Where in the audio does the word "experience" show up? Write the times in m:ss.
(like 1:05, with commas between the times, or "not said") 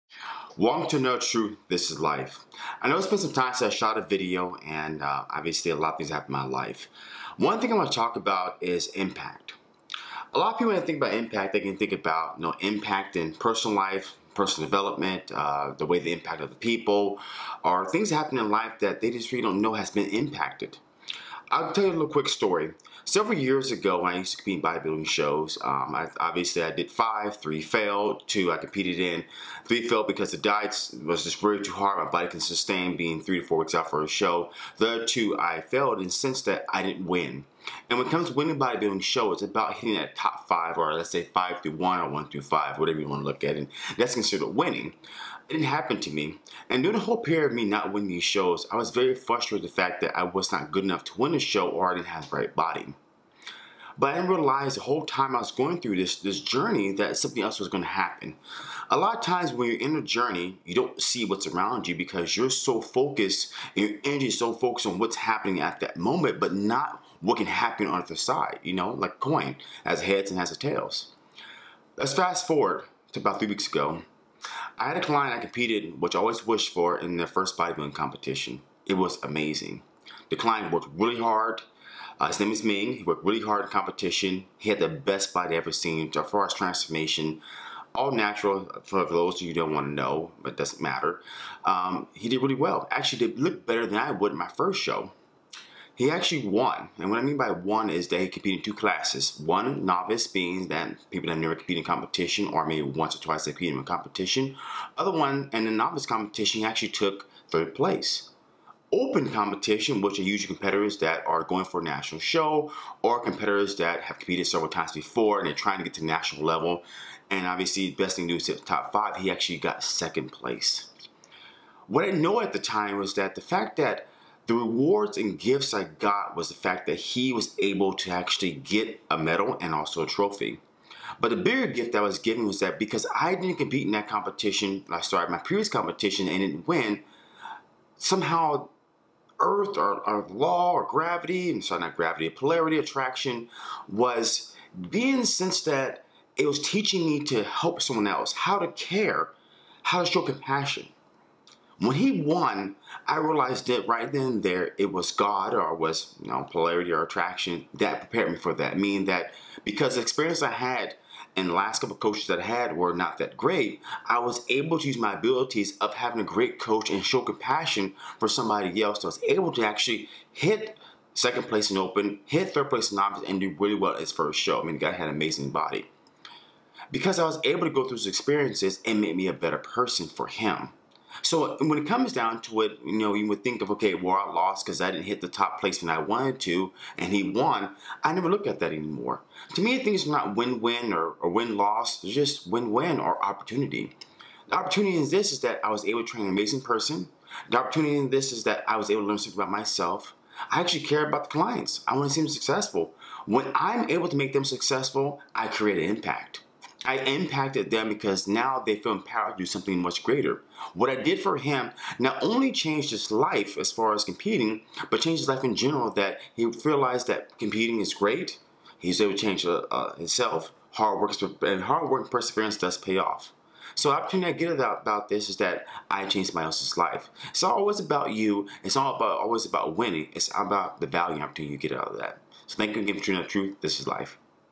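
2:40, 2:58.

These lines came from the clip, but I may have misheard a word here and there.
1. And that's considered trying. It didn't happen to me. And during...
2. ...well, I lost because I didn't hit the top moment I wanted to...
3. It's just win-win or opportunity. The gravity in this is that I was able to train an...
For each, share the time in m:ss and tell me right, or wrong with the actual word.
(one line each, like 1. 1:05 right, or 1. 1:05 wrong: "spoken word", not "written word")
1. 0:43 wrong: "winning", not "trying"
2. 3:03 wrong: "placement", not "moment"
3. 3:12 wrong: "opportunity", not "gravity".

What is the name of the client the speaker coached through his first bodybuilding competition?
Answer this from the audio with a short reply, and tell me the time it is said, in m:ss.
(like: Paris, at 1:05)
Ming, at 1:22.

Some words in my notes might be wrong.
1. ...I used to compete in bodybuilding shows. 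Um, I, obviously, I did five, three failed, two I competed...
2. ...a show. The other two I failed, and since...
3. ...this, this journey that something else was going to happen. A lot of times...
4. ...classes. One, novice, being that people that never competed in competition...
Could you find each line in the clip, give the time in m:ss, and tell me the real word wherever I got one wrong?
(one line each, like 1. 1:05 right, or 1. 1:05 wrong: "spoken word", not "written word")
1. 0:24 right
2. 0:34 right
3. 0:55 right
4. 1:38 right.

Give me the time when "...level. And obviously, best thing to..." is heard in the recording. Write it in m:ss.
1:56.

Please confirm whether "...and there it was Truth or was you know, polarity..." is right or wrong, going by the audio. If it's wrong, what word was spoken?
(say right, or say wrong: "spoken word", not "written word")
wrong: "God", not "Truth".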